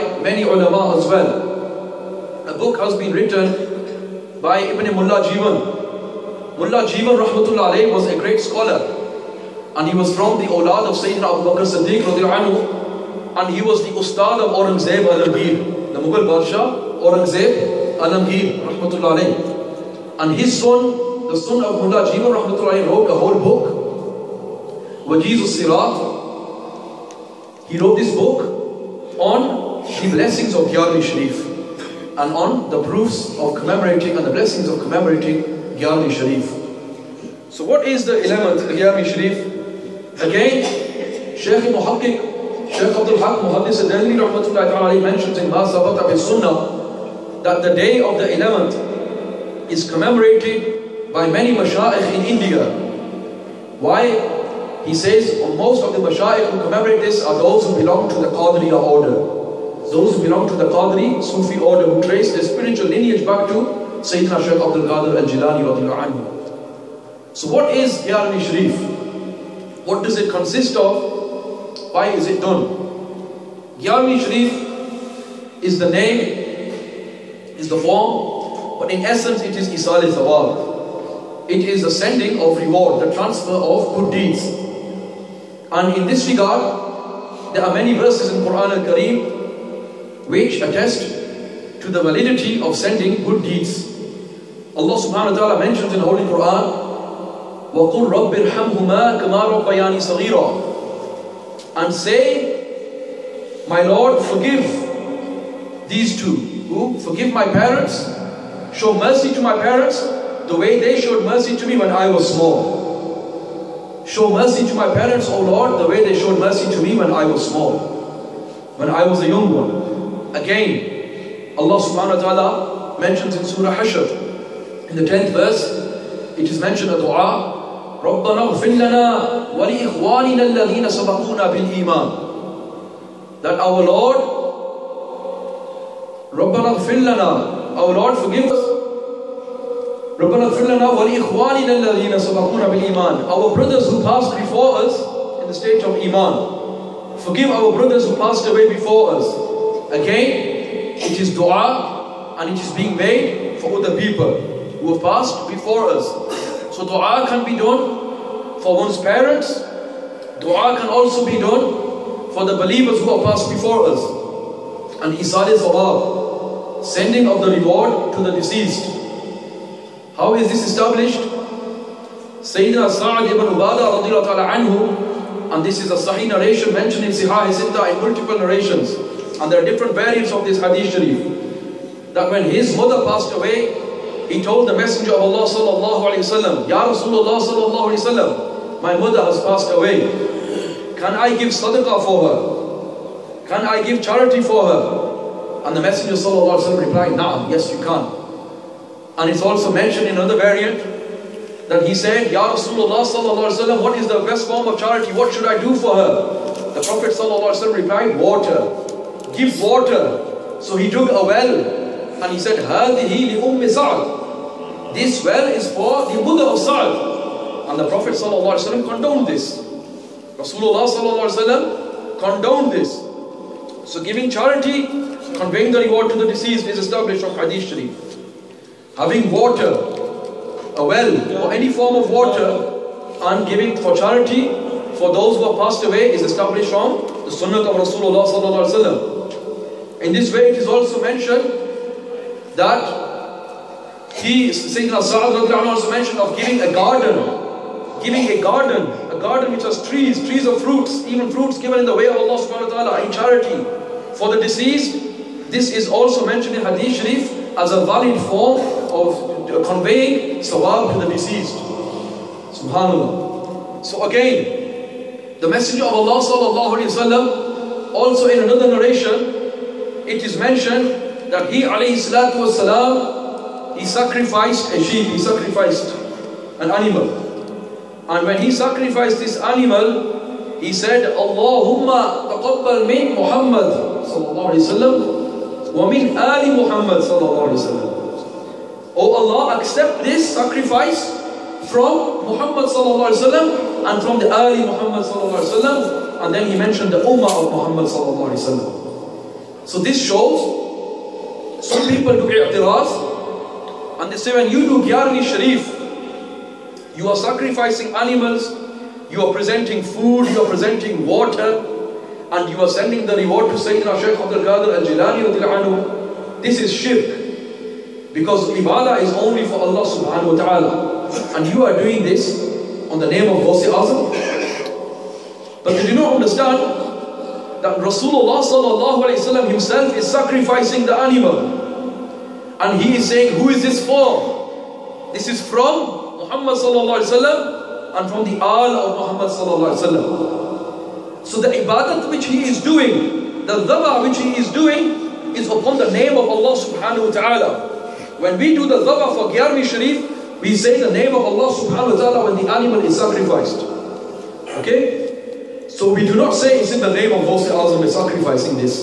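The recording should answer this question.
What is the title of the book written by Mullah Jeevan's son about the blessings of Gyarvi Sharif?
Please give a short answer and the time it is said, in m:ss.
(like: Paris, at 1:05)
Wajiz al-Sirat, at 0:25.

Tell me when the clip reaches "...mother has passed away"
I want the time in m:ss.
3:08.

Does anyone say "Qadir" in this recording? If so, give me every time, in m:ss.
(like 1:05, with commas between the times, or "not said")
1:04, 5:14.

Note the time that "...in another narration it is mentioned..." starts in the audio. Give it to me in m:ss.
4:28.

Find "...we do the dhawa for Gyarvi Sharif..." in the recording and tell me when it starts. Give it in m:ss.
5:48.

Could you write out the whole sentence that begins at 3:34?
This well is for the mother of Sa'ad.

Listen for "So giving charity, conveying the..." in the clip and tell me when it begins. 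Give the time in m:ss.
3:43.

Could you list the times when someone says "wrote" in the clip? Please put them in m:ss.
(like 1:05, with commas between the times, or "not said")
0:22, 0:27.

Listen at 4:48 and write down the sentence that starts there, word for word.
Oh Allah, accept this sacrifice from Muhammad sallallahu alaihi wasallam and from the ali Muhammad sallallahu alaihi wasallam.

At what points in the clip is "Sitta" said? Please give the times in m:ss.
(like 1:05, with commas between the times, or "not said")
2:57.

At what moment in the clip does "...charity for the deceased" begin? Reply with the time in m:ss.
4:13.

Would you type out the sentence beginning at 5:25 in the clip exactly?
But they do not understand that Rasulullah sallallahu himself is sacrificing the animal.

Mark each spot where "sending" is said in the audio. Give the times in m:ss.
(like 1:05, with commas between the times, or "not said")
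1:21, 1:32, 2:46, 5:12.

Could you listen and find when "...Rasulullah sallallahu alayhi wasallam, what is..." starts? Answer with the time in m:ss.
3:22.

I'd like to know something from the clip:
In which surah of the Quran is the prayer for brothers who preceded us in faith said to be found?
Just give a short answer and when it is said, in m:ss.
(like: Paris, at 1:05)
Surah Hashr, at 2:03.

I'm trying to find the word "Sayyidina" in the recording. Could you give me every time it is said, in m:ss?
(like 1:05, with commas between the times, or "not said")
0:10, 1:04, 2:52, 4:04, 5:13.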